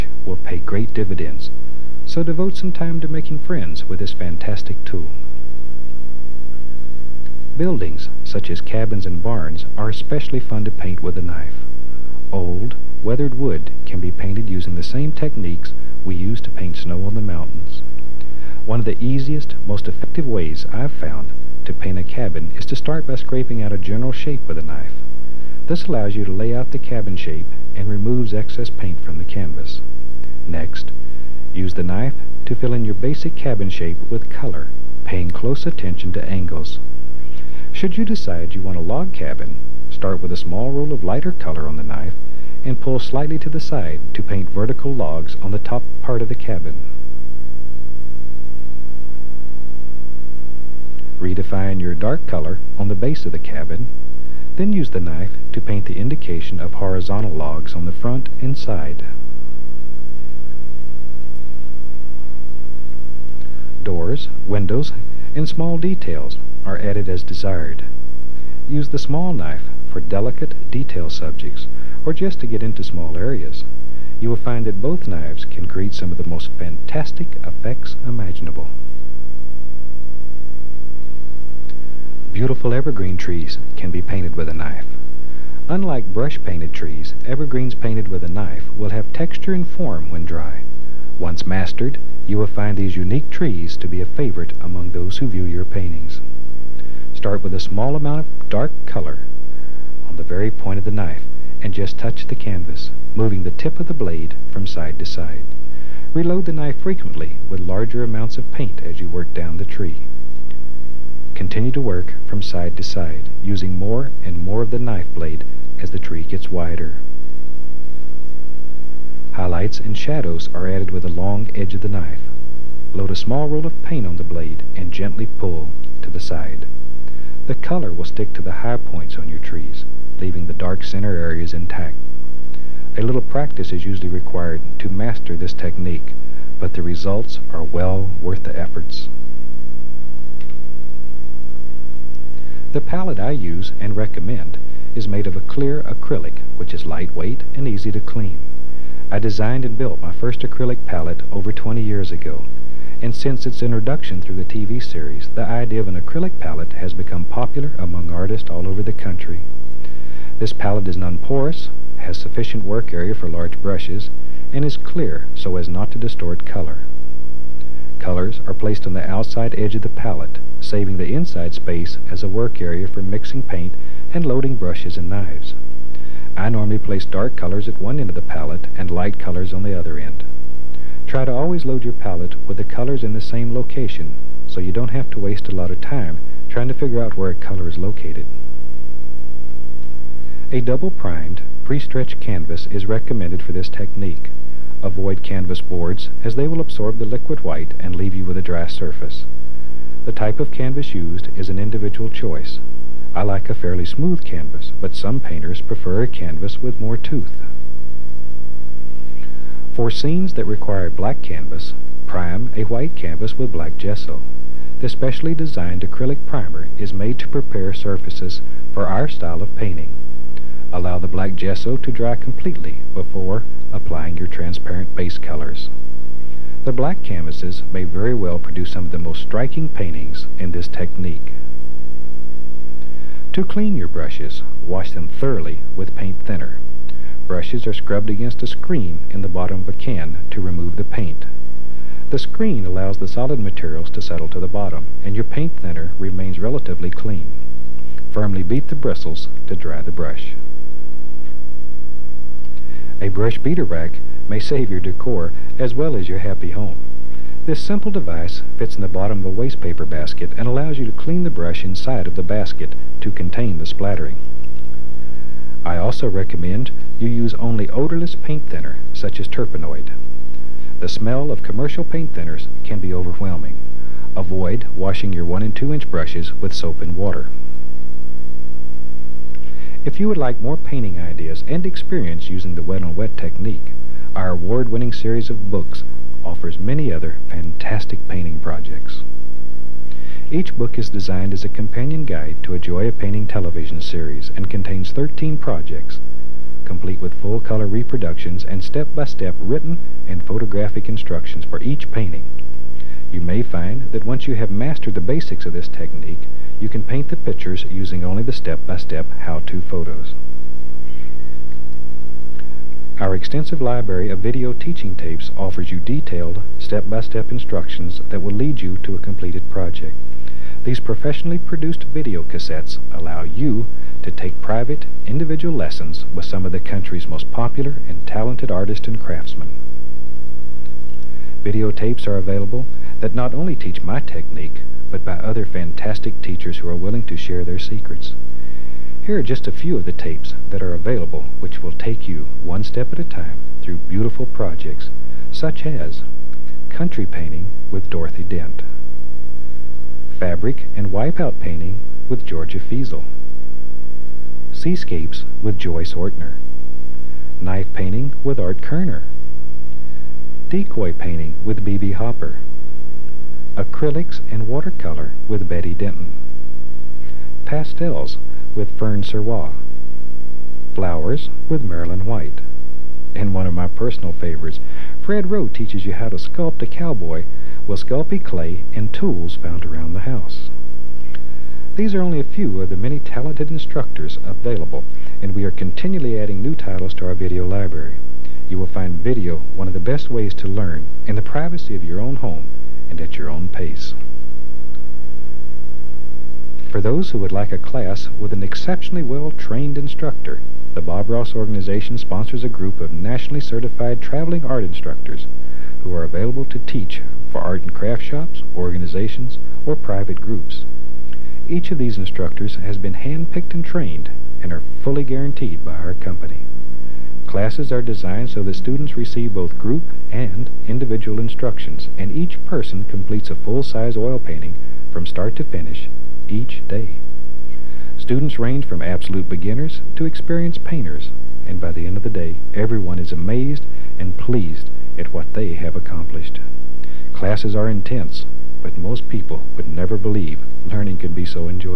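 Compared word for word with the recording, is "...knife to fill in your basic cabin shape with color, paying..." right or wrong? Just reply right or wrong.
right.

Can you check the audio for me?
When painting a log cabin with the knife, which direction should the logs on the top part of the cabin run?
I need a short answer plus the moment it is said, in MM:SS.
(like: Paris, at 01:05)
Vertical, at 00:44.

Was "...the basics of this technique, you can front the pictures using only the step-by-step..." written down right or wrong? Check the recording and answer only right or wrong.
wrong.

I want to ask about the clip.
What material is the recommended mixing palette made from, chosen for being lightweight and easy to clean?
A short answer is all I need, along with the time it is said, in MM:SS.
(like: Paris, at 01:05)
Clear acrylic, at 02:25.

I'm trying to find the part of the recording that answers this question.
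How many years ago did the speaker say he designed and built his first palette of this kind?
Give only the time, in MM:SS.
02:31.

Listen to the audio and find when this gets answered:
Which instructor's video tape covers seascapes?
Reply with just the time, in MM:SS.
05:55.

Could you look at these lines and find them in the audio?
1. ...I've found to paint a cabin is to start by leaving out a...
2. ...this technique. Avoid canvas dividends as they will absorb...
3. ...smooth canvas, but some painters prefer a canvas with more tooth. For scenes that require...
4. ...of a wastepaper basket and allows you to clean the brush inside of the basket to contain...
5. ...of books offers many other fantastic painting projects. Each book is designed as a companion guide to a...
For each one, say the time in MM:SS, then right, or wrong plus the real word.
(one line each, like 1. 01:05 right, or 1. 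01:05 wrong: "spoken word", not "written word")
1. 00:20 wrong: "scraping", not "leaving"
2. 03:13 wrong: "boards", not "dividends"
3. 03:23 right
4. 04:19 right
5. 04:45 right.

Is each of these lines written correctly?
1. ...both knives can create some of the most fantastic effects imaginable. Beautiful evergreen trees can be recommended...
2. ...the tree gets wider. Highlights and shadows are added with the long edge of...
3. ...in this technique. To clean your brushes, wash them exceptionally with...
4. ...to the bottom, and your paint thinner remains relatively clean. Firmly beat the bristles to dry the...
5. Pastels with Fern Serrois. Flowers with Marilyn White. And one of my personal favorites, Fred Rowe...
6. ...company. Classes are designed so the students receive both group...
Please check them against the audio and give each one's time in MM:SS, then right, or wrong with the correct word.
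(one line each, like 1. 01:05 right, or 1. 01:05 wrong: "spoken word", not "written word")
1. 01:14 wrong: "painted", not "recommended"
2. 01:55 right
3. 03:50 wrong: "thoroughly", not "exceptionally"
4. 04:04 right
5. 06:07 right
6. 06:55 right.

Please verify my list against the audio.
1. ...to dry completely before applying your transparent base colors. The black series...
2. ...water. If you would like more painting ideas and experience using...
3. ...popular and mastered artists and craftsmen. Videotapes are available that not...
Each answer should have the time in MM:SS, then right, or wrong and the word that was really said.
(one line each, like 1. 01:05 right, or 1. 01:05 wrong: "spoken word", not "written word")
1. 03:41 wrong: "canvases", not "series"
2. 04:36 right
3. 05:27 wrong: "talented", not "mastered".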